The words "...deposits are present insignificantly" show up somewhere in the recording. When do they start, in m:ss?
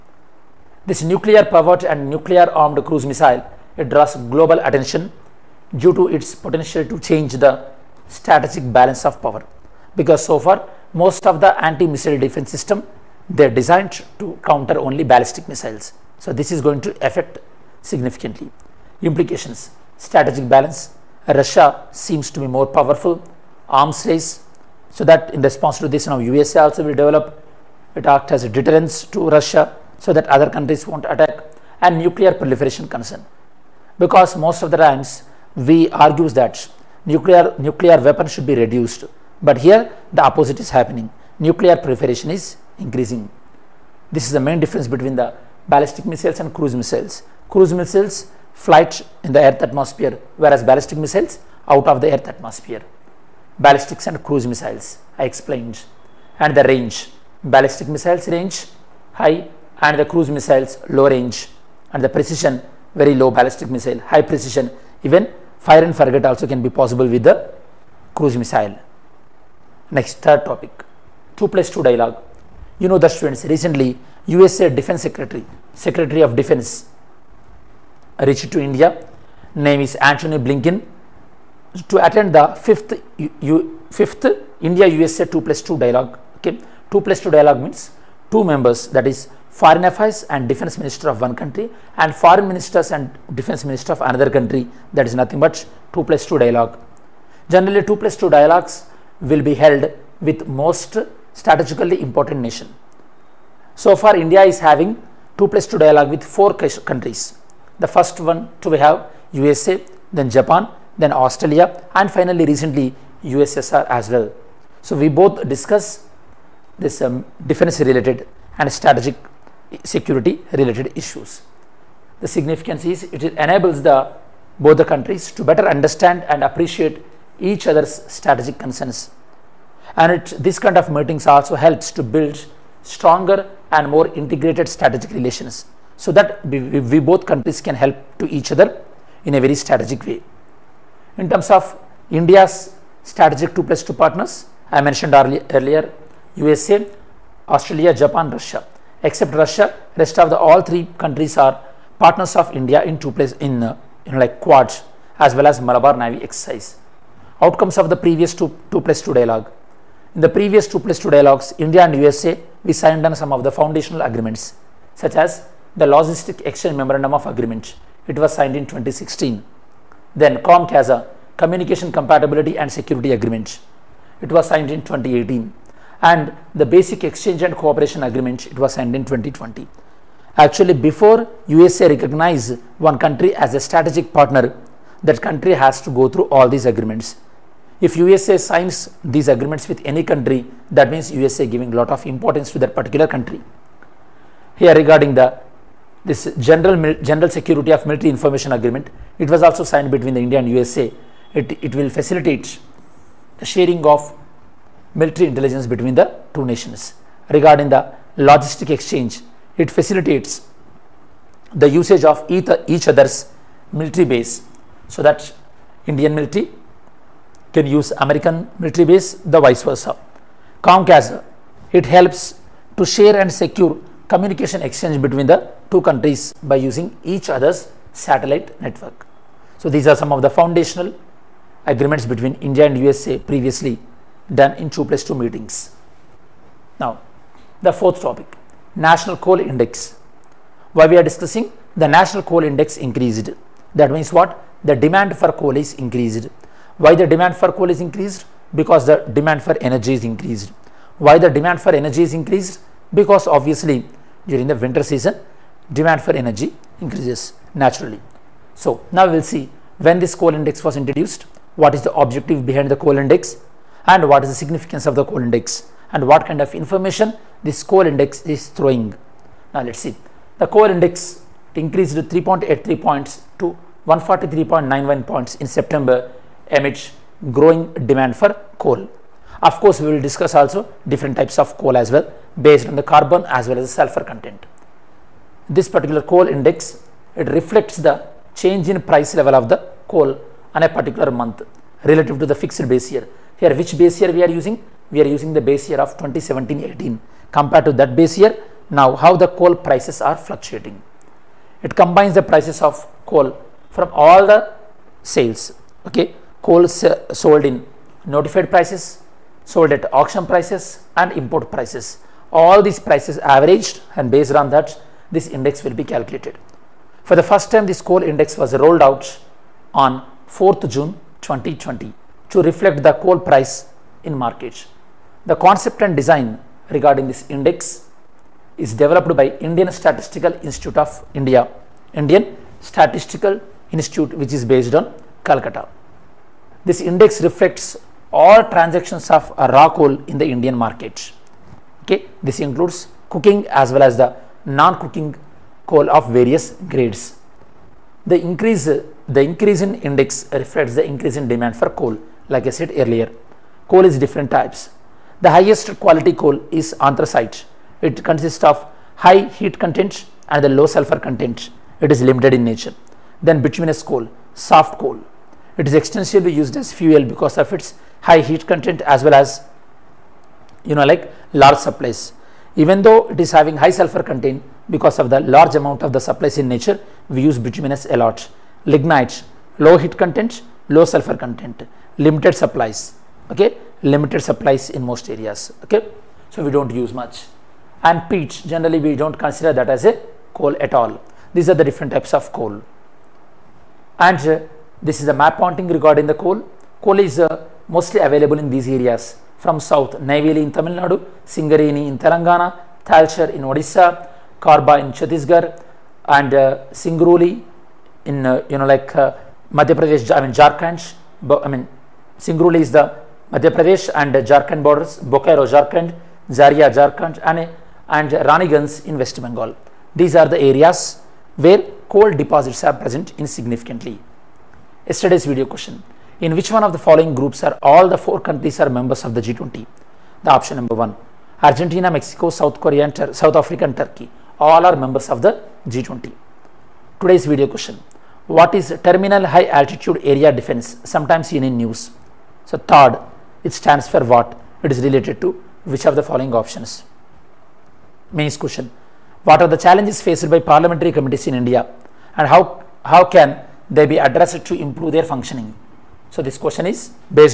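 7:02.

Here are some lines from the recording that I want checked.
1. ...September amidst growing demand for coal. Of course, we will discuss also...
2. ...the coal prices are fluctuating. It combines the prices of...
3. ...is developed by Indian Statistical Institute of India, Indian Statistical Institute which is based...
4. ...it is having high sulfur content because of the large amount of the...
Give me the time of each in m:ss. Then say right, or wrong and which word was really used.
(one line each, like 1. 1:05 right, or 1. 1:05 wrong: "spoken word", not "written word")
1. 4:35 right
2. 4:59 right
3. 5:28 right
4. 6:13 right.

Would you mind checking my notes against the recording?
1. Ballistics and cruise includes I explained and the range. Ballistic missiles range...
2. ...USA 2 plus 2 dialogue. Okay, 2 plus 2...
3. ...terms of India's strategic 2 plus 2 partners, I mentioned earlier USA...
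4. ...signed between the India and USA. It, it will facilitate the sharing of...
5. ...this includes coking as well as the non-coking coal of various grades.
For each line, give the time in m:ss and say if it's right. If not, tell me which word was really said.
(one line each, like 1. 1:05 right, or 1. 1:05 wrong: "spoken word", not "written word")
1. 0:53 wrong: "missiles", not "includes"
2. 1:24 right
3. 2:21 right
4. 3:19 right
5. 5:42 right.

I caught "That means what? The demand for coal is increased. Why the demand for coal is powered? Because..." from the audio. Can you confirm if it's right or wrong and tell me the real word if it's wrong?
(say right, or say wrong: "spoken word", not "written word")
wrong: "increased", not "powered".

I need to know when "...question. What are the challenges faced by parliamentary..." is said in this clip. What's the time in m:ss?
7:28.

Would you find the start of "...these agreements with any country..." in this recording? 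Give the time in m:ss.
3:09.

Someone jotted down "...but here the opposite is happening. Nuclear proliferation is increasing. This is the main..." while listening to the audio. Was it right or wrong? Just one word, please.
right.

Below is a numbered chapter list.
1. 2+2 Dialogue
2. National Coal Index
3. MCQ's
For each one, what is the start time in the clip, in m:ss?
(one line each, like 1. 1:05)
1. 1:10
2. 3:57
3. 7:04.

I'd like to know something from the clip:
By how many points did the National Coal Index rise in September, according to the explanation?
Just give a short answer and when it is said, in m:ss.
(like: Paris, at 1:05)
3.83 points, at 4:31.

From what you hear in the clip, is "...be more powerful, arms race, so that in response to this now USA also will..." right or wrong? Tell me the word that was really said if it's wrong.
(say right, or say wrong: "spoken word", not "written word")
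right.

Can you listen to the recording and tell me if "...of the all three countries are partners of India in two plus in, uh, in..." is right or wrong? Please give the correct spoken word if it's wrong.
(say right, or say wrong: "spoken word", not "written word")
right.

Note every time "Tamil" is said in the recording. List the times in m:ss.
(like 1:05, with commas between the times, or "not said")
6:40.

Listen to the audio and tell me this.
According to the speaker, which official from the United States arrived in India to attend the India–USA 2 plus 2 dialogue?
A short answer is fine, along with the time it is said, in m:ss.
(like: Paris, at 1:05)
Antony Blinken, at 1:19.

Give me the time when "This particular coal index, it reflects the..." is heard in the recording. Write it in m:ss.
4:45.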